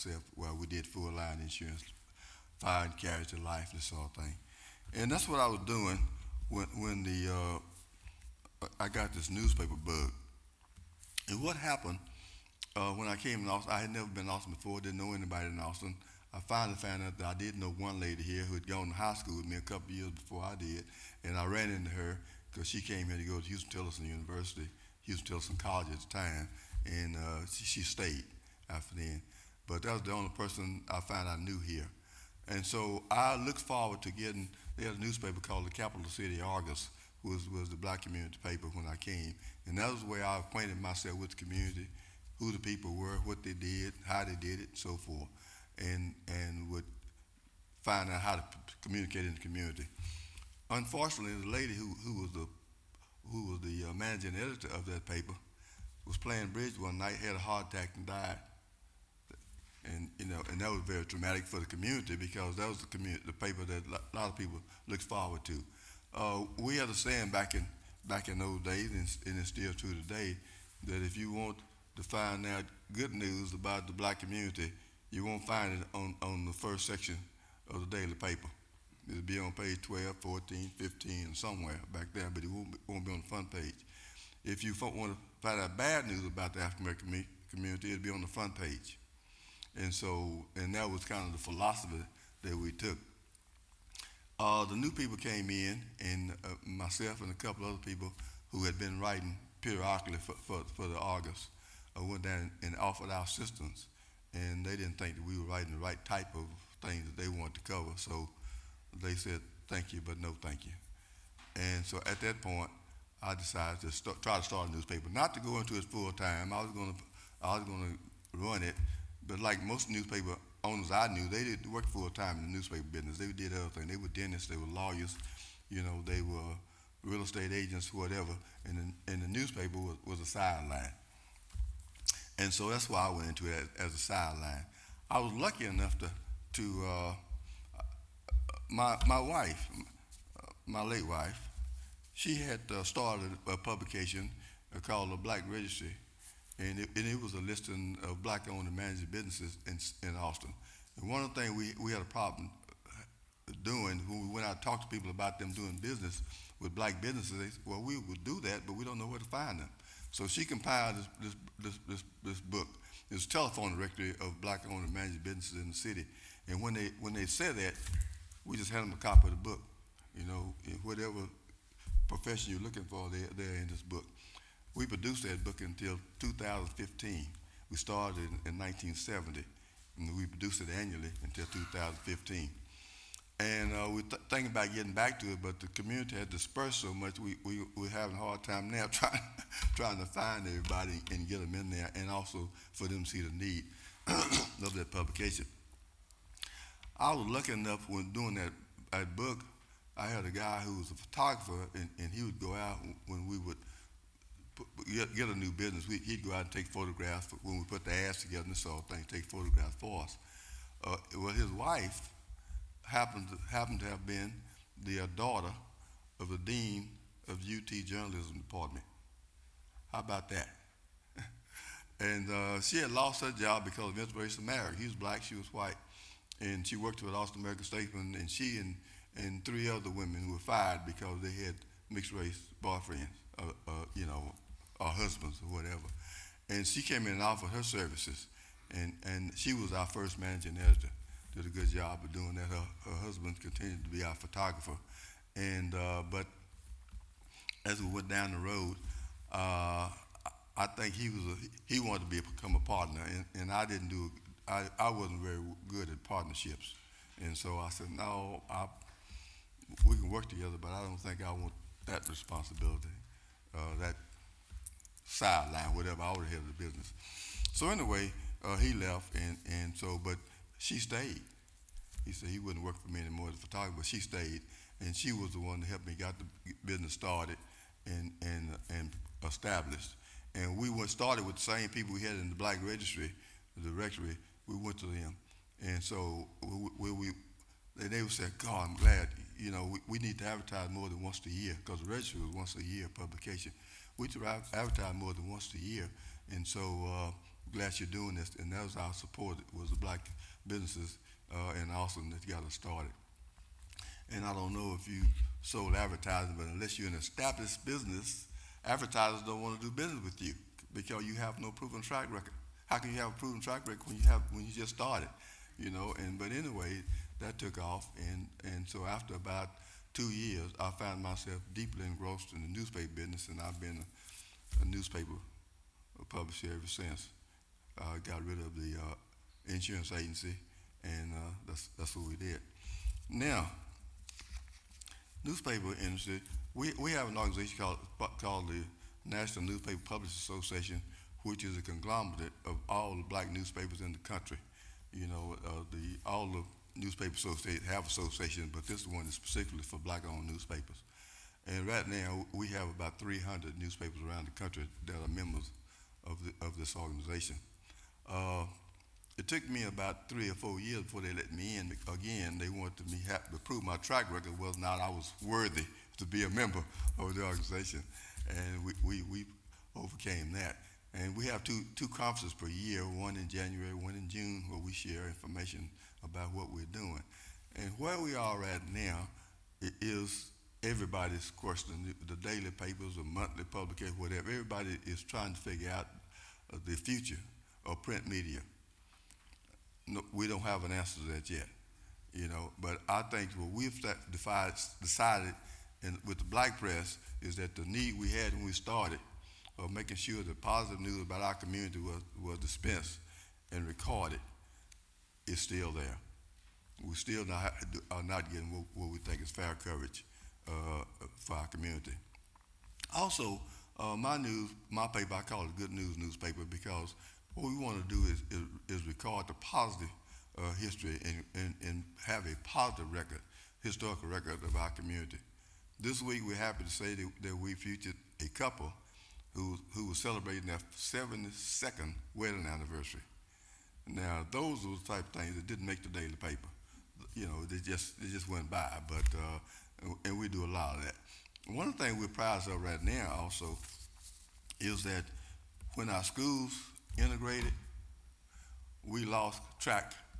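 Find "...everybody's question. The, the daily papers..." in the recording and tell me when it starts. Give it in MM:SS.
06:20.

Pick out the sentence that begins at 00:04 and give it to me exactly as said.
And that's what I was doing when, when the uh, I got this newspaper bug.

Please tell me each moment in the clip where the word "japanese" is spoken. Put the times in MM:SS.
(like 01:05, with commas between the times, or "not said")
not said.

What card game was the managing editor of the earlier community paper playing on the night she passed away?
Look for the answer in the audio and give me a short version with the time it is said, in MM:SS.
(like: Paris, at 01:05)
Bridge, at 00:56.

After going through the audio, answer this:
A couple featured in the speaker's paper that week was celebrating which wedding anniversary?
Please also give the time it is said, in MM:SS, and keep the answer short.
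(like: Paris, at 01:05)
72nd, at 07:10.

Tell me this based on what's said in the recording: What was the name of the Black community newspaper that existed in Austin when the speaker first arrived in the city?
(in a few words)
Capital City Argus.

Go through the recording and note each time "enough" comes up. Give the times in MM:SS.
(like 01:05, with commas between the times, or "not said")
02:15, 03:17.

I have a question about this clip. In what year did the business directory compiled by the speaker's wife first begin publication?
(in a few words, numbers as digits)
1970.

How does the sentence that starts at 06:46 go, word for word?
We still not, are not getting what, what we think is fair coverage uh, for our community.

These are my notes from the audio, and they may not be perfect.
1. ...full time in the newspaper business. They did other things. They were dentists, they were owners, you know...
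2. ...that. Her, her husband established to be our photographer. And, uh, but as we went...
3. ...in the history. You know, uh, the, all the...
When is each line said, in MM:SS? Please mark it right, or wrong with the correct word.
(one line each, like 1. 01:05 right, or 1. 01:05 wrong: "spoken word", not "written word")
1. 02:01 wrong: "lawyers", not "owners"
2. 04:02 wrong: "continued", not "established"
3. 05:43 wrong: "country", not "history".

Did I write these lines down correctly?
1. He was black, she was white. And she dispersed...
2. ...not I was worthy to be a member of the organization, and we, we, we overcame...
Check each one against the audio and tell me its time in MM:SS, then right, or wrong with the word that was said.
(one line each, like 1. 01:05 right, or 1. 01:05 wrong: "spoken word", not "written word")
1. 03:44 wrong: "worked", not "dispersed"
2. 06:04 right.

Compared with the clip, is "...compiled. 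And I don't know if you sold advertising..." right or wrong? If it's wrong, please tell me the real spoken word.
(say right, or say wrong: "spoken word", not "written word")
wrong: "started", not "compiled".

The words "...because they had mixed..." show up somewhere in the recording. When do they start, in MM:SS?
03:50.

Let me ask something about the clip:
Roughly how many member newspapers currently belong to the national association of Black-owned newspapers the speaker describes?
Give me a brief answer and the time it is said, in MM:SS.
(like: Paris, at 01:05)
300, at 05:52.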